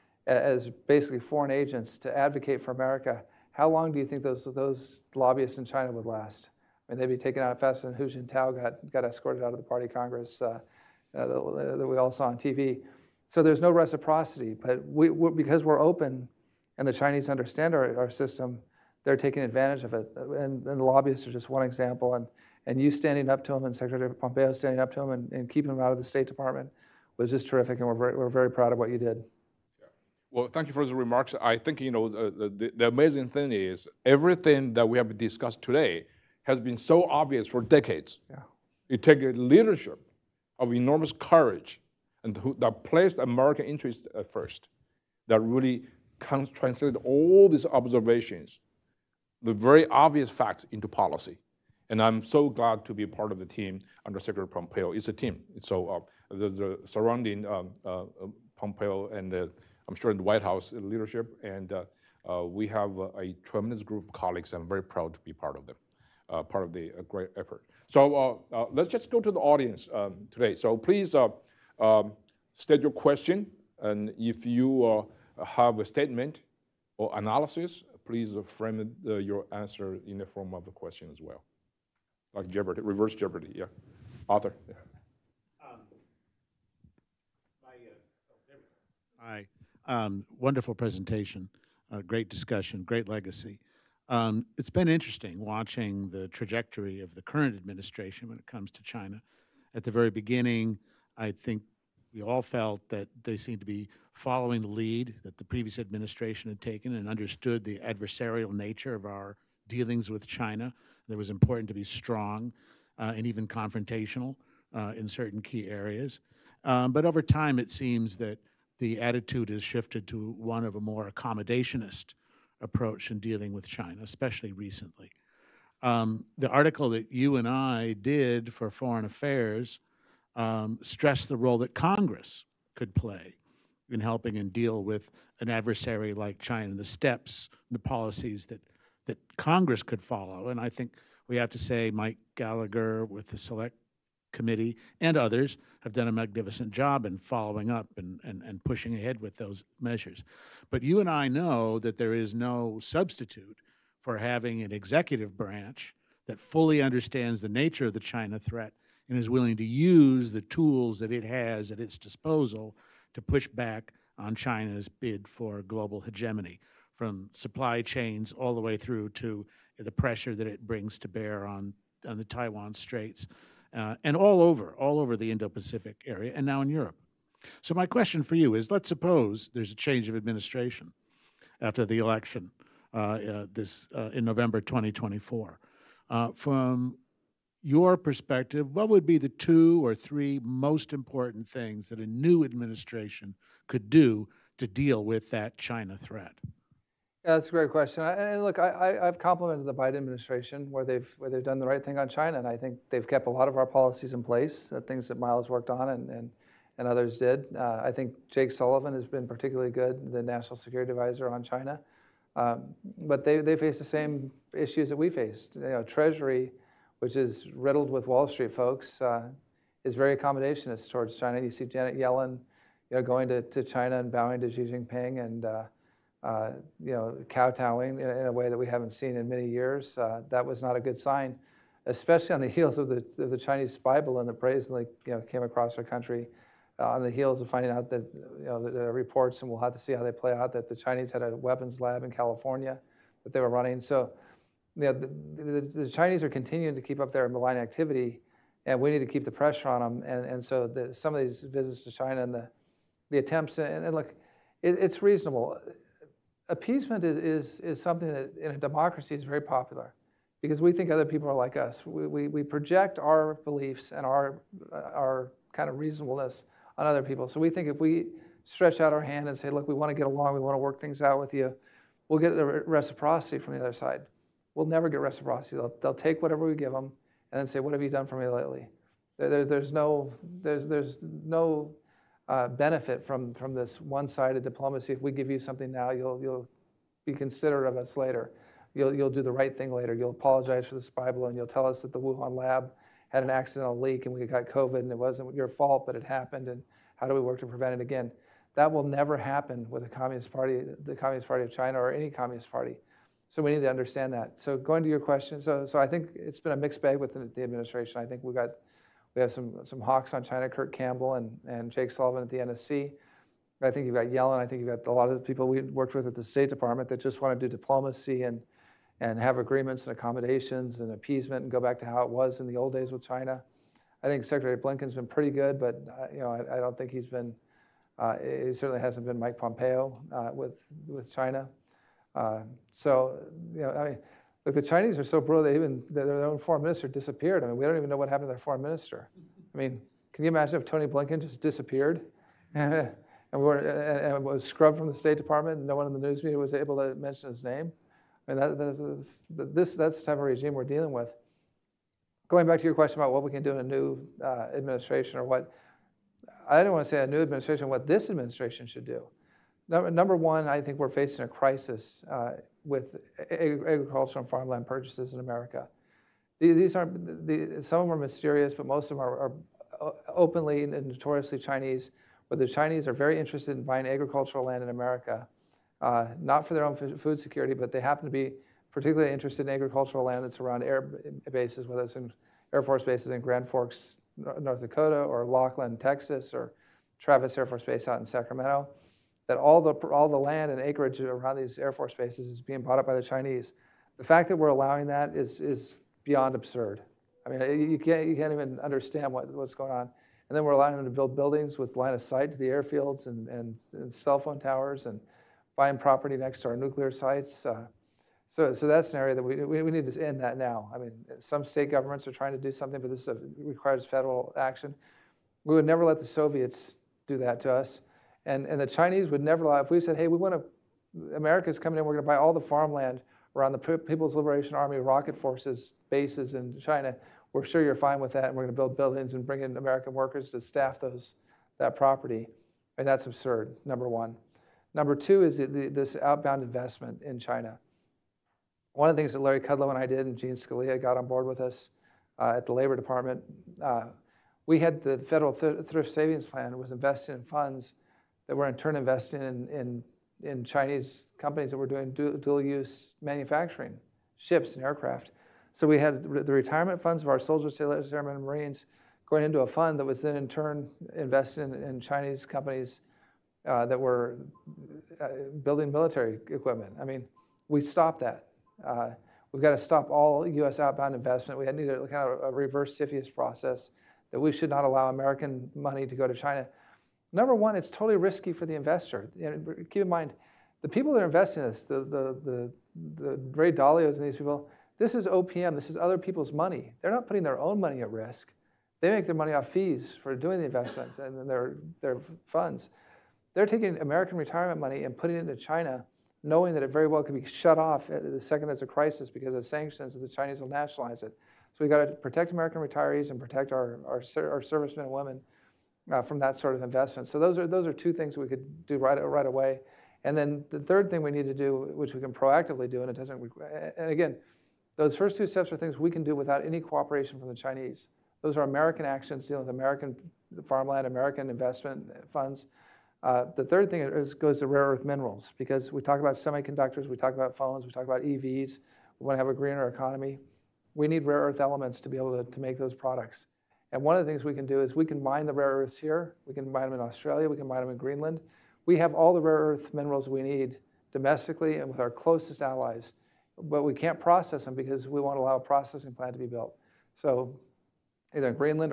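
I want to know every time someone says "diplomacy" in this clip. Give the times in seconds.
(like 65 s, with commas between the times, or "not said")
284 s, 317 s.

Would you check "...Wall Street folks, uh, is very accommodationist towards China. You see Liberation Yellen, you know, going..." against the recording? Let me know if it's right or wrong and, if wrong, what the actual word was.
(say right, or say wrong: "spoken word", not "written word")
wrong: "Janet", not "Liberation".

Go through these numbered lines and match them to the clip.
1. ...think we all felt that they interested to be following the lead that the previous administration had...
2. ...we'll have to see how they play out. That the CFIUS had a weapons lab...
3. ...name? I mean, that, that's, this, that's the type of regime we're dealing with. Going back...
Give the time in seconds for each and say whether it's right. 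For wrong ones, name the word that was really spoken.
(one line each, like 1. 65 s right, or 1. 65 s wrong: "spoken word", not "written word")
1. 101 s wrong: "seemed", not "interested"
2. 239 s wrong: "Chinese", not "CFIUS"
3. 347 s right.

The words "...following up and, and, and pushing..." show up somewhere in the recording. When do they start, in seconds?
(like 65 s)
147 s.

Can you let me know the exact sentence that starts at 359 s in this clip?
Number, one, I think we're facing a crisis uh, with agricultural and farmland purchases in America.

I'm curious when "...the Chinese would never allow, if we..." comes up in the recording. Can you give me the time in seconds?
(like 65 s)
418 s.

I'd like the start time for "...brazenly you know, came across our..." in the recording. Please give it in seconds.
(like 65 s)
234 s.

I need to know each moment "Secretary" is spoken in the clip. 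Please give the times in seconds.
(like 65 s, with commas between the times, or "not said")
23 s, 54 s, 324 s.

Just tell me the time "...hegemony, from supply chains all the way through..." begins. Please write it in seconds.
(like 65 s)
166 s.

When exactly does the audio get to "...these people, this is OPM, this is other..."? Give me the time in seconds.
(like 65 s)
484 s.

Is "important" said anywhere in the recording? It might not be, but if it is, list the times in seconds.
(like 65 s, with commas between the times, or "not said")
111 s, 190 s.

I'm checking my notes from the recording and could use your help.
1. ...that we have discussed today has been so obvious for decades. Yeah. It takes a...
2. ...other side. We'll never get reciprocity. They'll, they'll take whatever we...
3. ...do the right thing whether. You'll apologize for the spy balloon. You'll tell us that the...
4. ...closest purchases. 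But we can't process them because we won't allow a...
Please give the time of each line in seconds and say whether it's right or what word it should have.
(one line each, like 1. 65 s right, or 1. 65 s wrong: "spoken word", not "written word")
1. 34 s right
2. 273 s right
3. 289 s wrong: "later", not "whether"
4. 541 s wrong: "allies", not "purchases".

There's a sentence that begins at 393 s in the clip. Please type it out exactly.
The fact that we're allowing that is, is beyond absurd.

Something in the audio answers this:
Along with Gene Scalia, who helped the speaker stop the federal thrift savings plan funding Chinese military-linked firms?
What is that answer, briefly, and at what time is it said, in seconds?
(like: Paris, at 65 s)
Larry Kudlow, at 439 s.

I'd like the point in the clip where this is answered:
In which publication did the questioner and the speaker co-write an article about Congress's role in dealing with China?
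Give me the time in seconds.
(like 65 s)
128 s.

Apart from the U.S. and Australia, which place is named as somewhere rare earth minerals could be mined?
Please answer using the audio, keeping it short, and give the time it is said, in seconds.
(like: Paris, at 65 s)
Greenland, at 537 s.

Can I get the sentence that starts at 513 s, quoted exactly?
And again, those first two steps are things we can do without any cooperation from the Chinese.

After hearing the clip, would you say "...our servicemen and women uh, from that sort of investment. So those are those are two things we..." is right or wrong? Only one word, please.
right.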